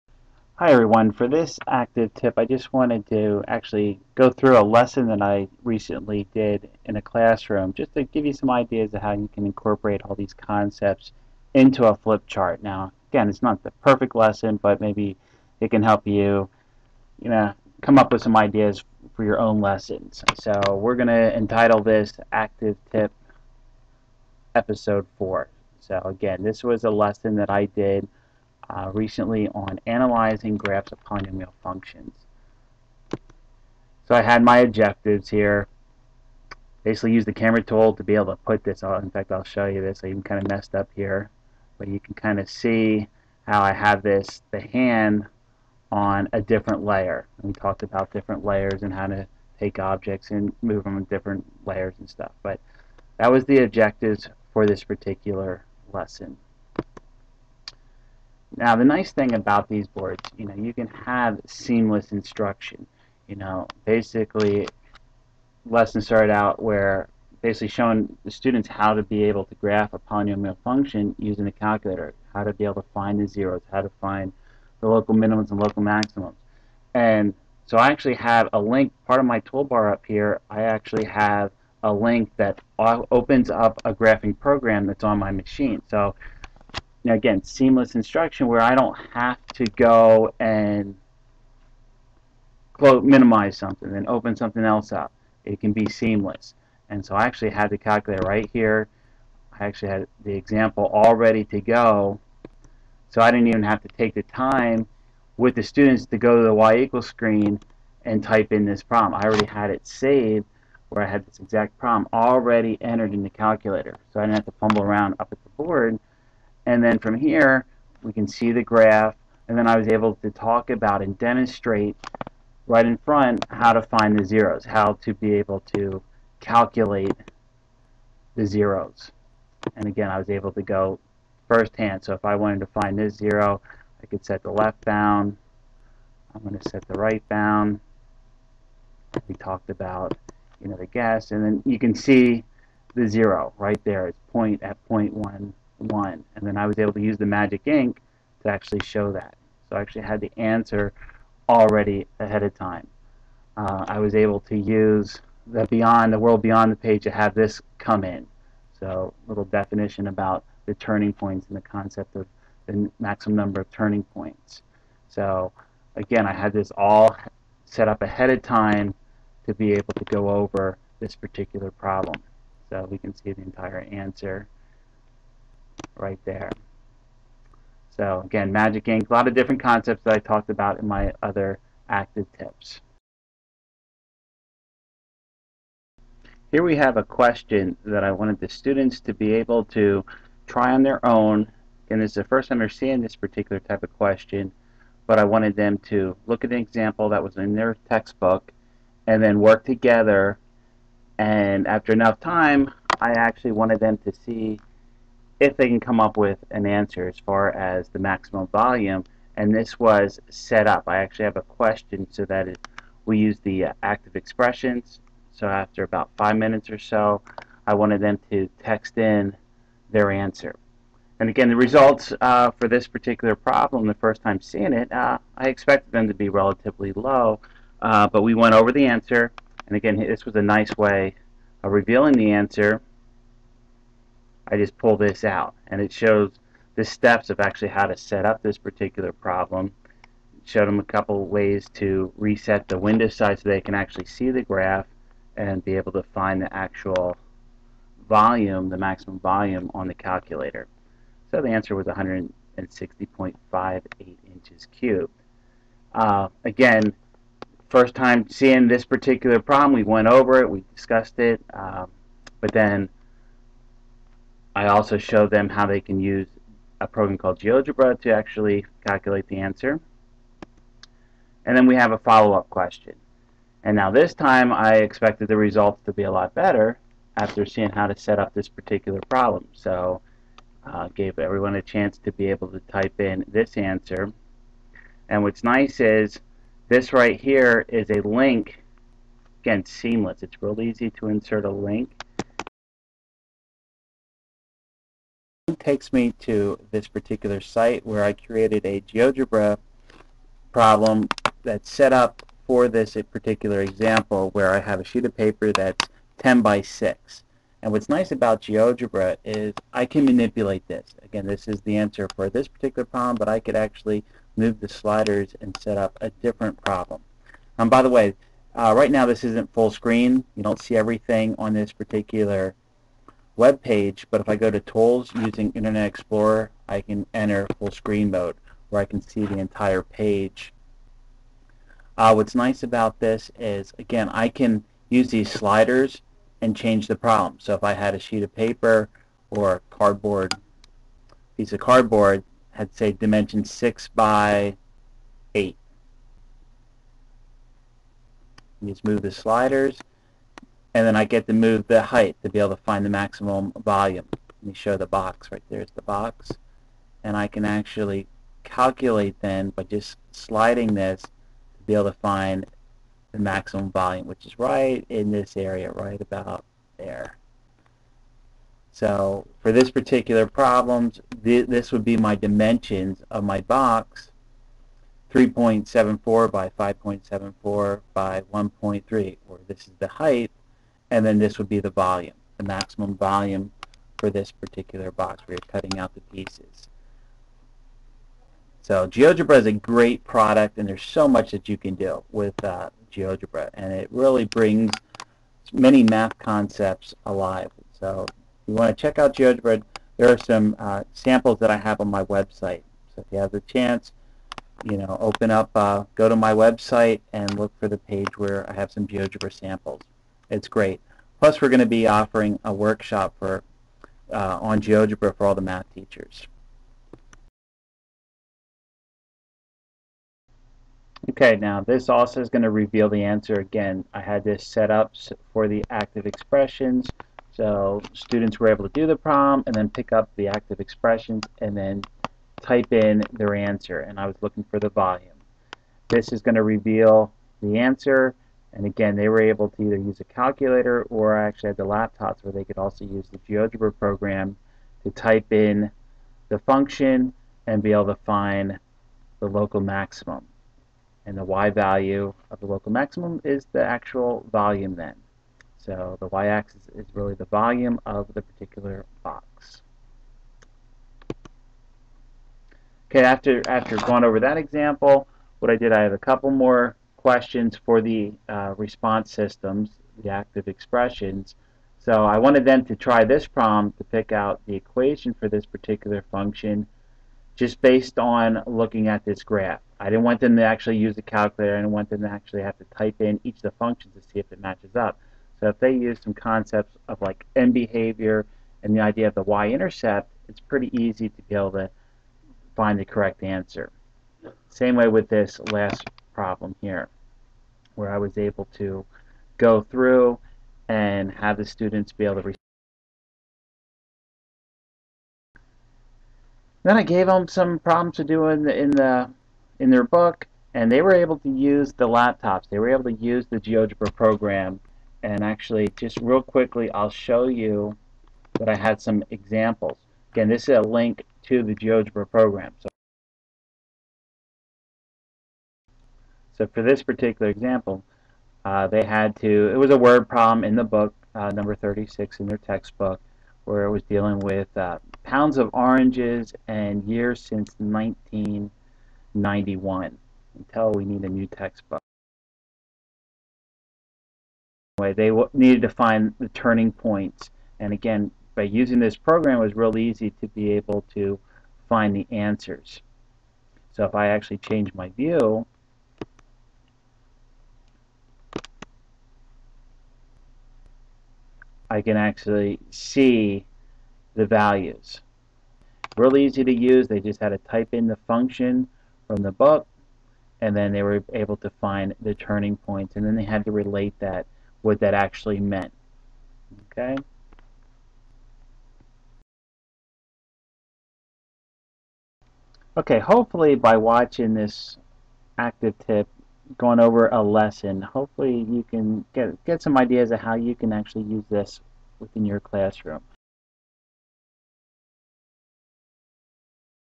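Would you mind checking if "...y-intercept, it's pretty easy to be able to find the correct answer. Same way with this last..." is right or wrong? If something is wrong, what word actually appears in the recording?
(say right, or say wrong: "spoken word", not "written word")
right.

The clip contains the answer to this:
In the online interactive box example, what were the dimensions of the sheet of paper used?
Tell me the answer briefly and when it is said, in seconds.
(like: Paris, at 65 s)
10 by 6, at 306 s.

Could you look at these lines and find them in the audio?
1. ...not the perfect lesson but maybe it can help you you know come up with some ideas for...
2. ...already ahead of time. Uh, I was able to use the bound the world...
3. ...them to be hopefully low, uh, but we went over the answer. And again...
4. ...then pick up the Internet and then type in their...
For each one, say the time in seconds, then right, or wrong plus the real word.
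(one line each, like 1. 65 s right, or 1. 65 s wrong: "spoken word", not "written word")
1. 13 s right
2. 151 s wrong: "beyond", not "bound"
3. 225 s wrong: "relatively", not "hopefully"
4. 429 s wrong: "Activexpressions", not "Internet".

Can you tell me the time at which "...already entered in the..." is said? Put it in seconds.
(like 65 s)
112 s.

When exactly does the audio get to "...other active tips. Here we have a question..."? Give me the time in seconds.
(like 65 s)
181 s.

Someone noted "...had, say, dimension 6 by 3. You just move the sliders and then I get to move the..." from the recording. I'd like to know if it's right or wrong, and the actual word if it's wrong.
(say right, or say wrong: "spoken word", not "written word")
wrong: "8", not "3".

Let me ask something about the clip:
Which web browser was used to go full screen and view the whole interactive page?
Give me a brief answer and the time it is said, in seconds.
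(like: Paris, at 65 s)
Internet Explorer, at 325 s.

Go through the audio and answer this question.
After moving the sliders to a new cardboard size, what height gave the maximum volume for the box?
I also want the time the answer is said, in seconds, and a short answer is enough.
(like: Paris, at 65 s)
1.3, at 378 s.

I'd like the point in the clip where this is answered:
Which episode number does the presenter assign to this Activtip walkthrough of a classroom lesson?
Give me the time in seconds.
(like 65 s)
24 s.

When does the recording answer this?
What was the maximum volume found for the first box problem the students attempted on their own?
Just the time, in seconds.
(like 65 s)
251 s.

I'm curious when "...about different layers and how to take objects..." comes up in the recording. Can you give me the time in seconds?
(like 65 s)
47 s.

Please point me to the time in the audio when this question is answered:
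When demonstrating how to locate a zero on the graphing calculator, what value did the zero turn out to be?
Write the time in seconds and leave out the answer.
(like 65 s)
144 s.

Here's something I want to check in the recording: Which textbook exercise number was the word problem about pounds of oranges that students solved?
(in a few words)
36.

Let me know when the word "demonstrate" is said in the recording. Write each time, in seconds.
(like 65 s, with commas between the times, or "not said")
121 s.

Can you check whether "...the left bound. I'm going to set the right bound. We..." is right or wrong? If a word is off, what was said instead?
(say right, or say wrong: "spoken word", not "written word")
right.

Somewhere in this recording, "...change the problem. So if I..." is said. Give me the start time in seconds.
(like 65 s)
336 s.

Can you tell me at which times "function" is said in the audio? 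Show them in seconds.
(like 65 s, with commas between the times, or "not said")
31 s, 70 s, 446 s, 476 s, 483 s, 568 s.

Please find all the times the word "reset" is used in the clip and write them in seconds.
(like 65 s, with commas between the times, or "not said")
242 s.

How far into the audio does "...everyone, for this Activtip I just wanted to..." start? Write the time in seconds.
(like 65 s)
0 s.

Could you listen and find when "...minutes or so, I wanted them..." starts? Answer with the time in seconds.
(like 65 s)
216 s.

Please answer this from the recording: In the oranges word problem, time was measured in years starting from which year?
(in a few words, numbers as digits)
1991.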